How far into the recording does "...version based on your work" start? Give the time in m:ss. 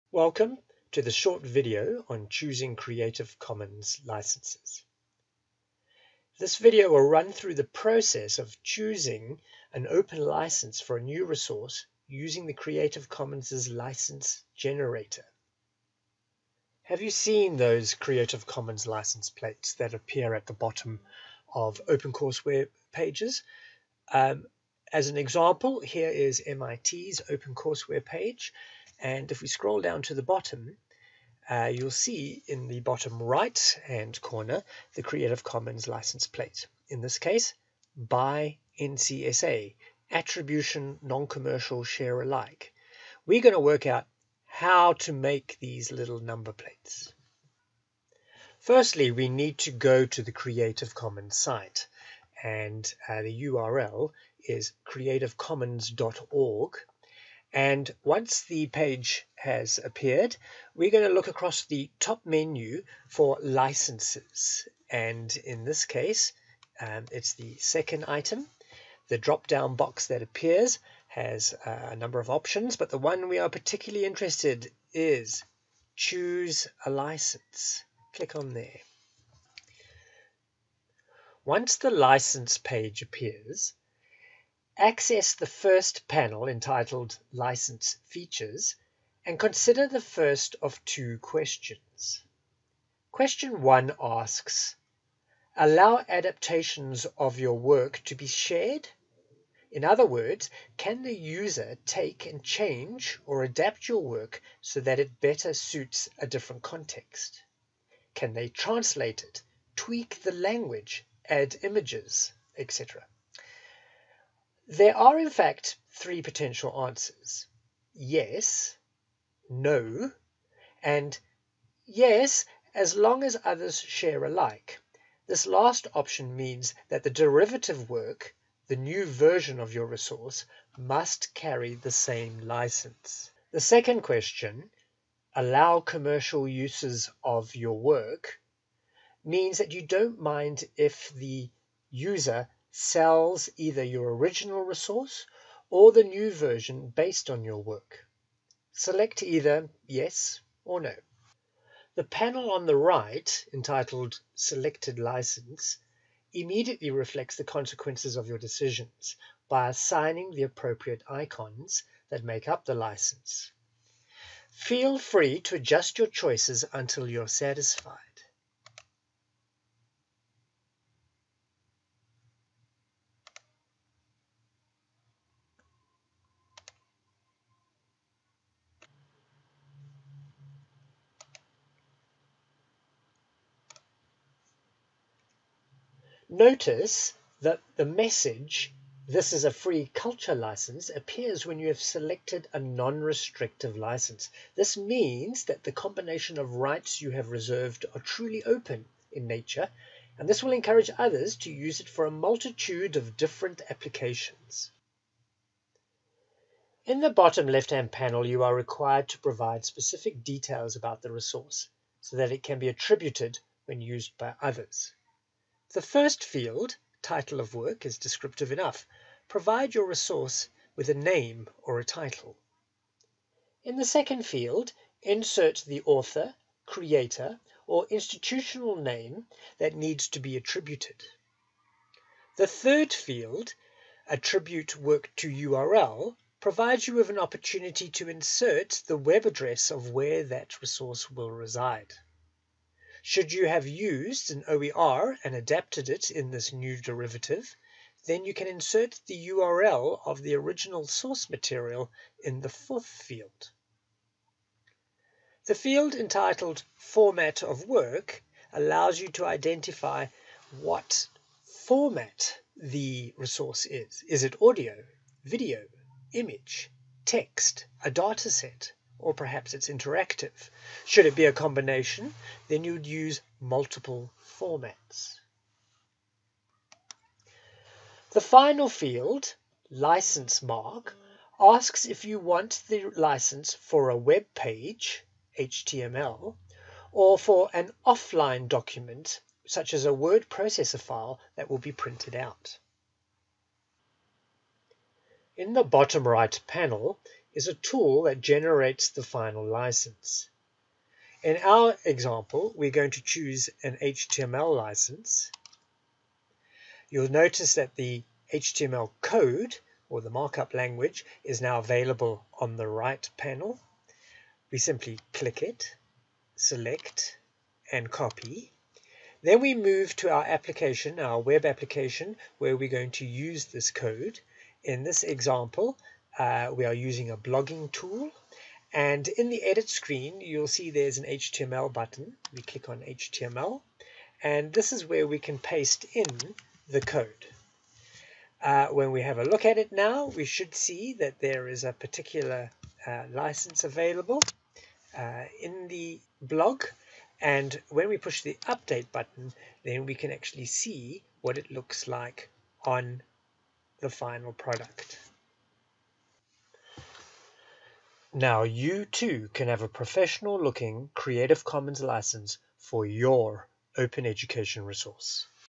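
2:26.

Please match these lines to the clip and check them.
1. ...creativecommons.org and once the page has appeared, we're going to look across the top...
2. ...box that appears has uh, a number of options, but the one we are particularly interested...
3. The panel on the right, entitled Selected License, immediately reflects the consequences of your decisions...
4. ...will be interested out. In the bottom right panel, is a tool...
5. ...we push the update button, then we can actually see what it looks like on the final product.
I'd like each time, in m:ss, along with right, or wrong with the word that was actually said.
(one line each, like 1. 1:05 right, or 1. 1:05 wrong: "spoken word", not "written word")
1. 0:54 right
2. 1:09 right
3. 2:31 right
4. 4:51 wrong: "printed", not "interested"
5. 5:47 right.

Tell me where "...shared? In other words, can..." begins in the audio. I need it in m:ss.
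1:38.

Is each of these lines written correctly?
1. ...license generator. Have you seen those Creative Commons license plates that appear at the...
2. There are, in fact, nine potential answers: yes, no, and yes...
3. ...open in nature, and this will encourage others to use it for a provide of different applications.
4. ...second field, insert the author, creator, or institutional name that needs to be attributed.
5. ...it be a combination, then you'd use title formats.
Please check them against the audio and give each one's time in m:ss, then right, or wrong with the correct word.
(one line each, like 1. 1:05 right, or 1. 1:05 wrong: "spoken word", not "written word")
1. 0:13 right
2. 1:54 wrong: "three", not "nine"
3. 3:18 wrong: "multitude", not "provide"
4. 3:43 right
5. 4:31 wrong: "multiple", not "title".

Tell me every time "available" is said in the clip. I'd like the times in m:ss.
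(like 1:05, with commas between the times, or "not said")
5:11, 5:43.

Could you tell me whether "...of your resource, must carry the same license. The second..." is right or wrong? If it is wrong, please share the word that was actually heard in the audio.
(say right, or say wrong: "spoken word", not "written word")
right.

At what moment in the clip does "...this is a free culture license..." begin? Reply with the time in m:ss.
3:09.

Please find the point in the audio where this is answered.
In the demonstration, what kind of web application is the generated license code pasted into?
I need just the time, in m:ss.
5:27.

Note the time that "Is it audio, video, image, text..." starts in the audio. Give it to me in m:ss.
4:24.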